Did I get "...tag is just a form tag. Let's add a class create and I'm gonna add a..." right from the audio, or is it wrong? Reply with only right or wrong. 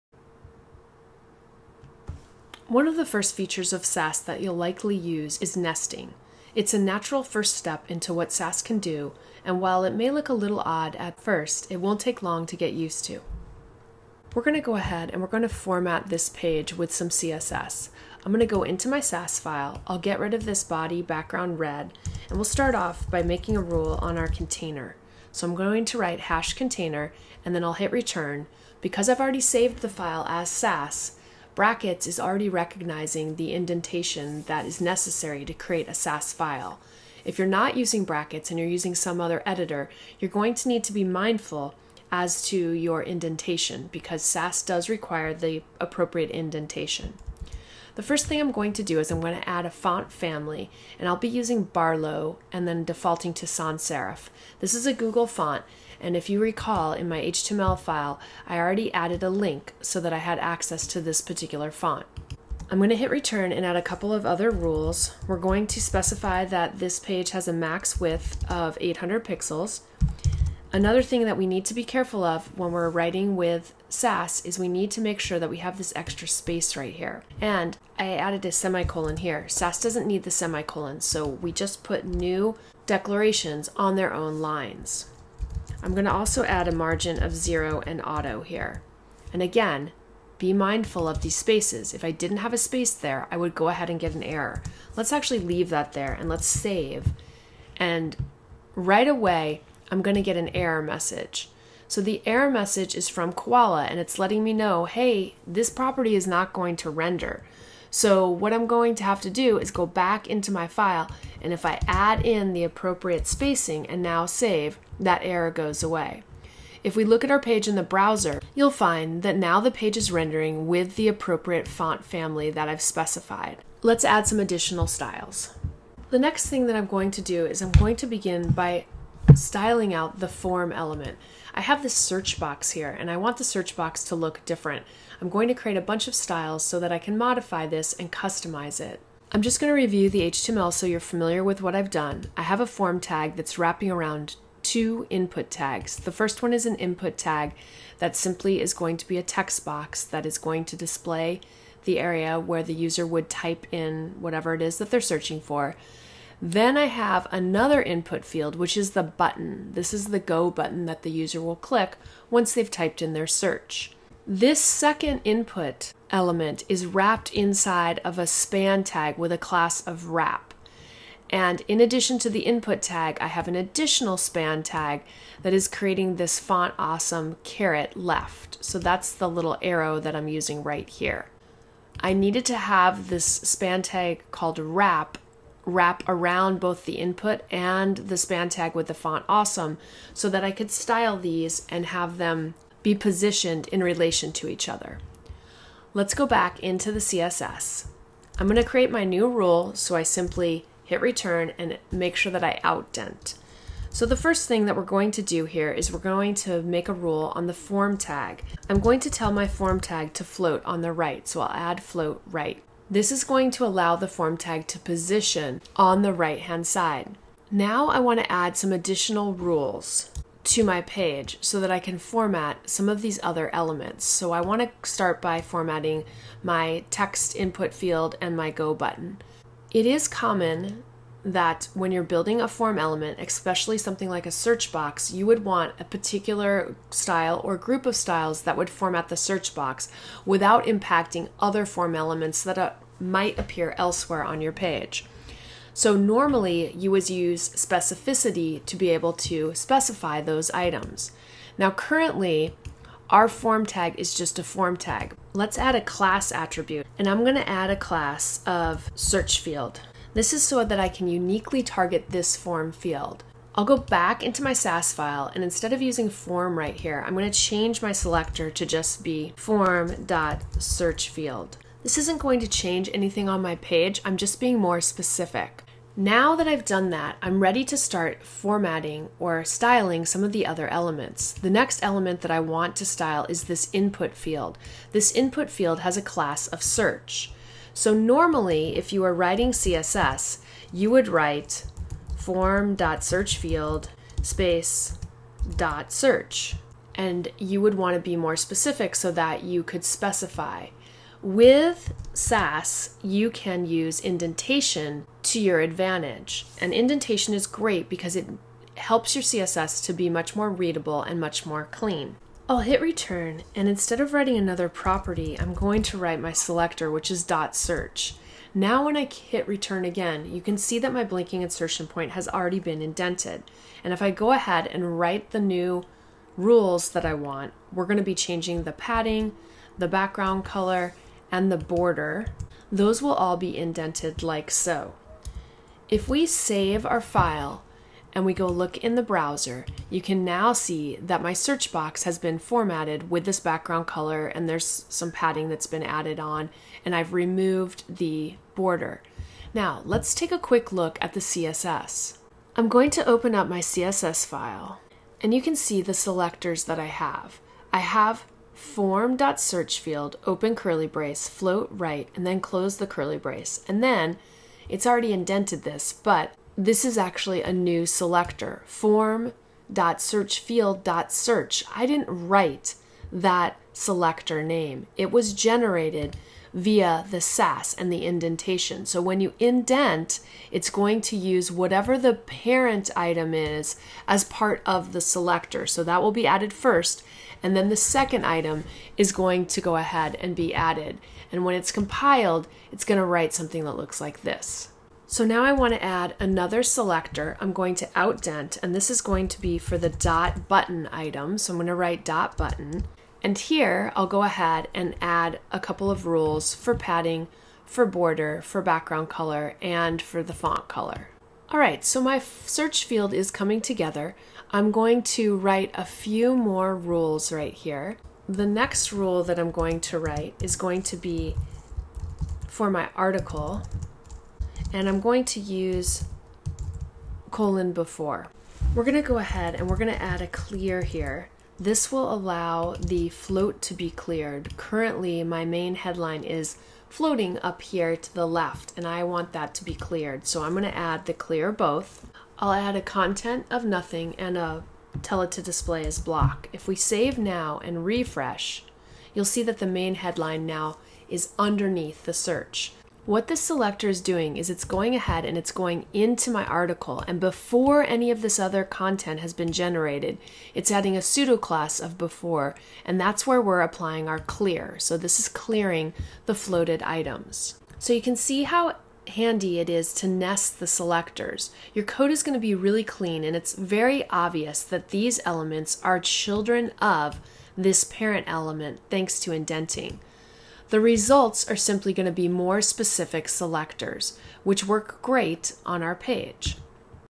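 wrong.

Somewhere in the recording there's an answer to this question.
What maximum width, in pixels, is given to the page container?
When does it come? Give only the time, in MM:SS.
01:08.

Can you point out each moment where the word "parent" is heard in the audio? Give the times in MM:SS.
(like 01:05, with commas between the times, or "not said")
06:22, 07:57.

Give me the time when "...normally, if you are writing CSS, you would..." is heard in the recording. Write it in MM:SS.
04:47.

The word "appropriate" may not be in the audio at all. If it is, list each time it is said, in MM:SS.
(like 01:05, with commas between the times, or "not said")
00:45, 01:52, 02:01.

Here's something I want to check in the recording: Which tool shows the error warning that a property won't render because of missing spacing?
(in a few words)
Koala.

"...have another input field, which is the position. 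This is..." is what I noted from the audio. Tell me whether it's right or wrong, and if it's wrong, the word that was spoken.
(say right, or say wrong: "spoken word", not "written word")
wrong: "button", not "position".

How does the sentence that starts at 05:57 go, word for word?
I have form.search field, open curly brace, float right, and then close the curly brace.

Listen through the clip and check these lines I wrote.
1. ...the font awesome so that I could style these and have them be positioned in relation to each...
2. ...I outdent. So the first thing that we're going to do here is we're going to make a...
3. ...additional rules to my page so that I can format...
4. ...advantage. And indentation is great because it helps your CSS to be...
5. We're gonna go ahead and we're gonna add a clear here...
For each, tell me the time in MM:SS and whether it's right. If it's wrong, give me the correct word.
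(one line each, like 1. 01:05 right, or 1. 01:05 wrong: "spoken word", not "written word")
1. 03:08 right
2. 03:22 right
3. 03:38 right
4. 05:05 right
5. 07:08 right.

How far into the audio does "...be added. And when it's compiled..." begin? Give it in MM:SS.
06:30.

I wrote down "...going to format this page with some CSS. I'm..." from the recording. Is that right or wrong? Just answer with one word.
right.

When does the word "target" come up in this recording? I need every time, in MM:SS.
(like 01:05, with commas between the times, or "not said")
04:21.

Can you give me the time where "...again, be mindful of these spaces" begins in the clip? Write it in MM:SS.
01:29.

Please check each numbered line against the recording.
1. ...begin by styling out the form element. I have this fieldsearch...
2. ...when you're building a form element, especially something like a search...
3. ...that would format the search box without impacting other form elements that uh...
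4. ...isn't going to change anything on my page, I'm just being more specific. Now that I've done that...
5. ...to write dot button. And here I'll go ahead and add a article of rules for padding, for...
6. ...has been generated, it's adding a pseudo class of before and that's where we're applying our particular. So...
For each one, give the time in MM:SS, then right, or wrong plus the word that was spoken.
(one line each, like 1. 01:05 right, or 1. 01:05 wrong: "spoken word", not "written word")
1. 02:08 wrong: "search", not "fieldsearch"
2. 03:51 right
3. 03:58 right
4. 04:31 right
5. 06:41 wrong: "couple", not "article"
6. 07:39 wrong: "clear", not "particular".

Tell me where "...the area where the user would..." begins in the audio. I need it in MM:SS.
02:31.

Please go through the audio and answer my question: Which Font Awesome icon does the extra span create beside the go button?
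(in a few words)
caret left.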